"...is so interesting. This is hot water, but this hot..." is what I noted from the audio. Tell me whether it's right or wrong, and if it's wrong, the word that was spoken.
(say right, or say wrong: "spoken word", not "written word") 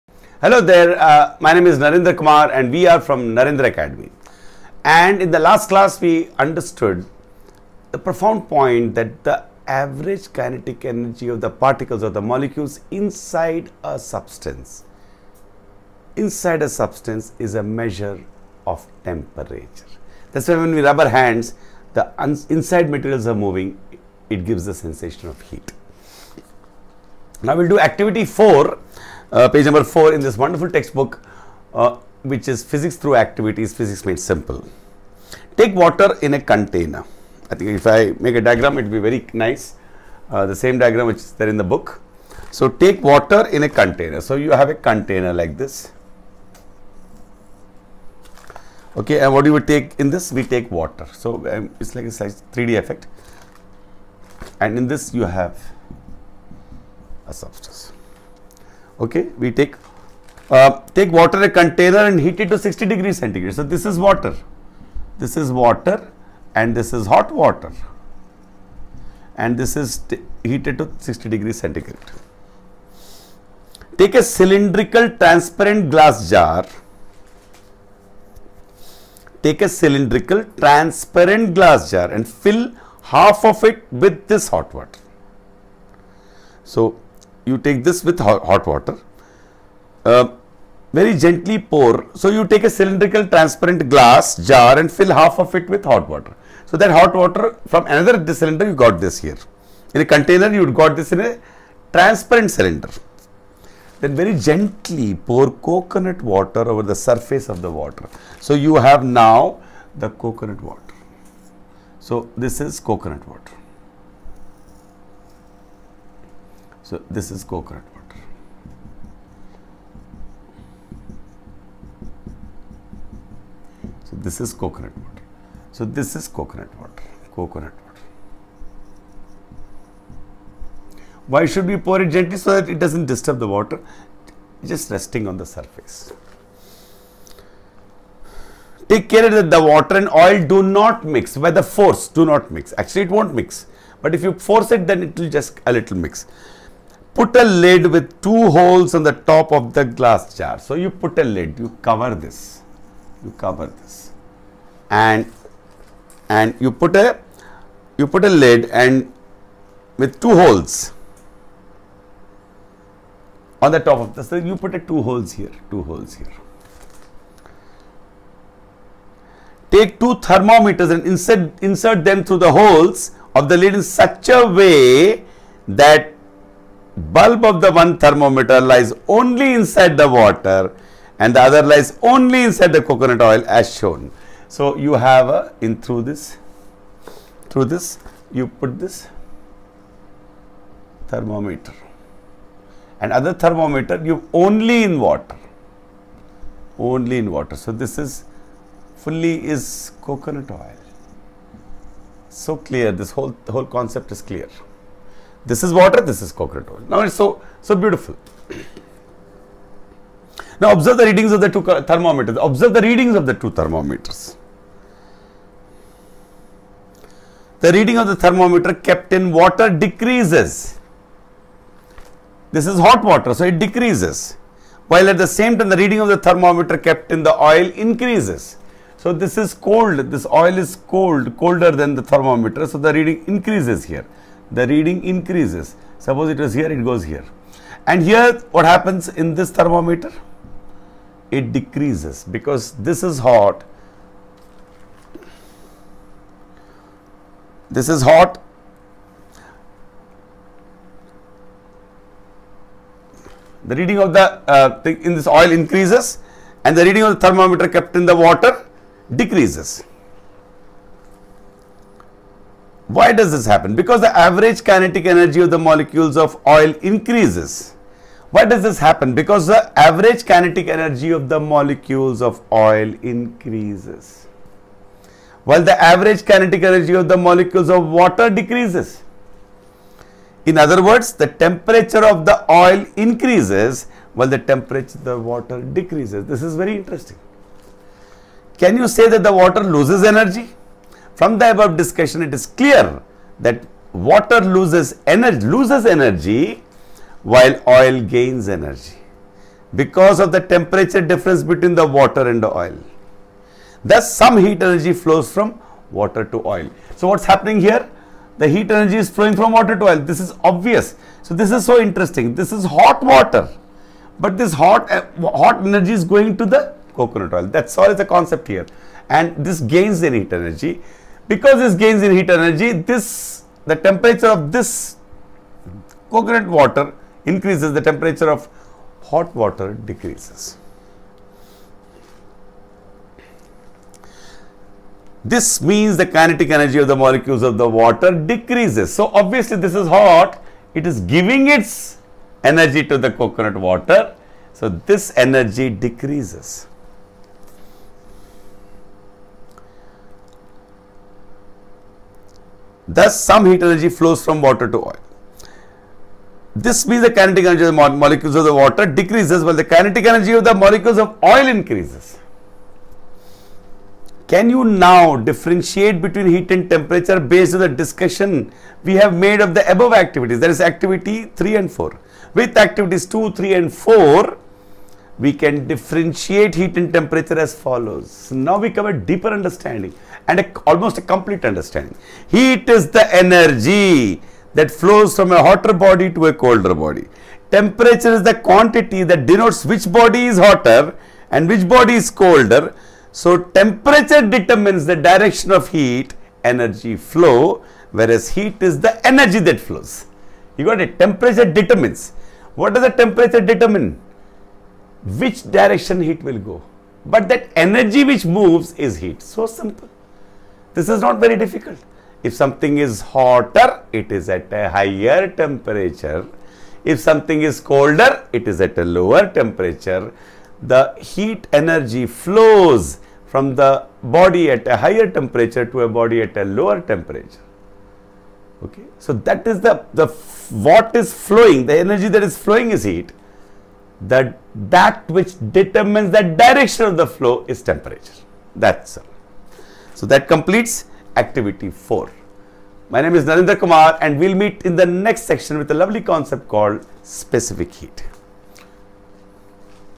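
right.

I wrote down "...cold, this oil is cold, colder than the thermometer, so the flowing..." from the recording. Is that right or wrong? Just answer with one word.
wrong.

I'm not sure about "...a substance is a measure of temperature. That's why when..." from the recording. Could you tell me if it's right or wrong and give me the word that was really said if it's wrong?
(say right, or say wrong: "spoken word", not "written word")
right.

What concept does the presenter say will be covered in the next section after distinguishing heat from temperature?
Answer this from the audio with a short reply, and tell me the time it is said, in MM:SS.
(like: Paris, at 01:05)
Specific heat, at 07:27.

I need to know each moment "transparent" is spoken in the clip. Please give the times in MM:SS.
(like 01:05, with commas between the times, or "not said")
01:15, 01:20, 01:33, 01:41.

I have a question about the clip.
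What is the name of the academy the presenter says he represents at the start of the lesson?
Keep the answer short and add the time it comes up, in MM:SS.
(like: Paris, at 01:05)
Narendra Academy, at 00:03.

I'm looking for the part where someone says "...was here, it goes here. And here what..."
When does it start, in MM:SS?
03:56.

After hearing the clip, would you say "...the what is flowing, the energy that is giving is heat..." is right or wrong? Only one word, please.
wrong.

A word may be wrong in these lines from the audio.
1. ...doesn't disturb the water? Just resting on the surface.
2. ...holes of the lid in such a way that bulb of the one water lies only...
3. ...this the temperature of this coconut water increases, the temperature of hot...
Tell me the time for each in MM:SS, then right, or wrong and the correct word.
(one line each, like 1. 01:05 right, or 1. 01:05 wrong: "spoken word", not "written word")
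1. 02:12 right
2. 02:52 wrong: "thermometer", not "water"
3. 05:22 right.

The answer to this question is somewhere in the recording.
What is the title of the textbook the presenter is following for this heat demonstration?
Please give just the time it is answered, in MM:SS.
00:32.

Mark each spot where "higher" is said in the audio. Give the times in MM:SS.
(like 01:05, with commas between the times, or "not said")
06:54, 07:04.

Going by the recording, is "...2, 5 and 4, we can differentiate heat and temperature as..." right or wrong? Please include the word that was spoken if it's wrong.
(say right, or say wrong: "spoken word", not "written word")
wrong: "3", not "5".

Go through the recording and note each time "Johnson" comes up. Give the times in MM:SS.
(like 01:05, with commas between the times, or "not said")
not said.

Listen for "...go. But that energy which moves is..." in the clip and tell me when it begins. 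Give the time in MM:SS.
06:46.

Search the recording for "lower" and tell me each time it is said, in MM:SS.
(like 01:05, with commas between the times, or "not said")
06:58, 07:06.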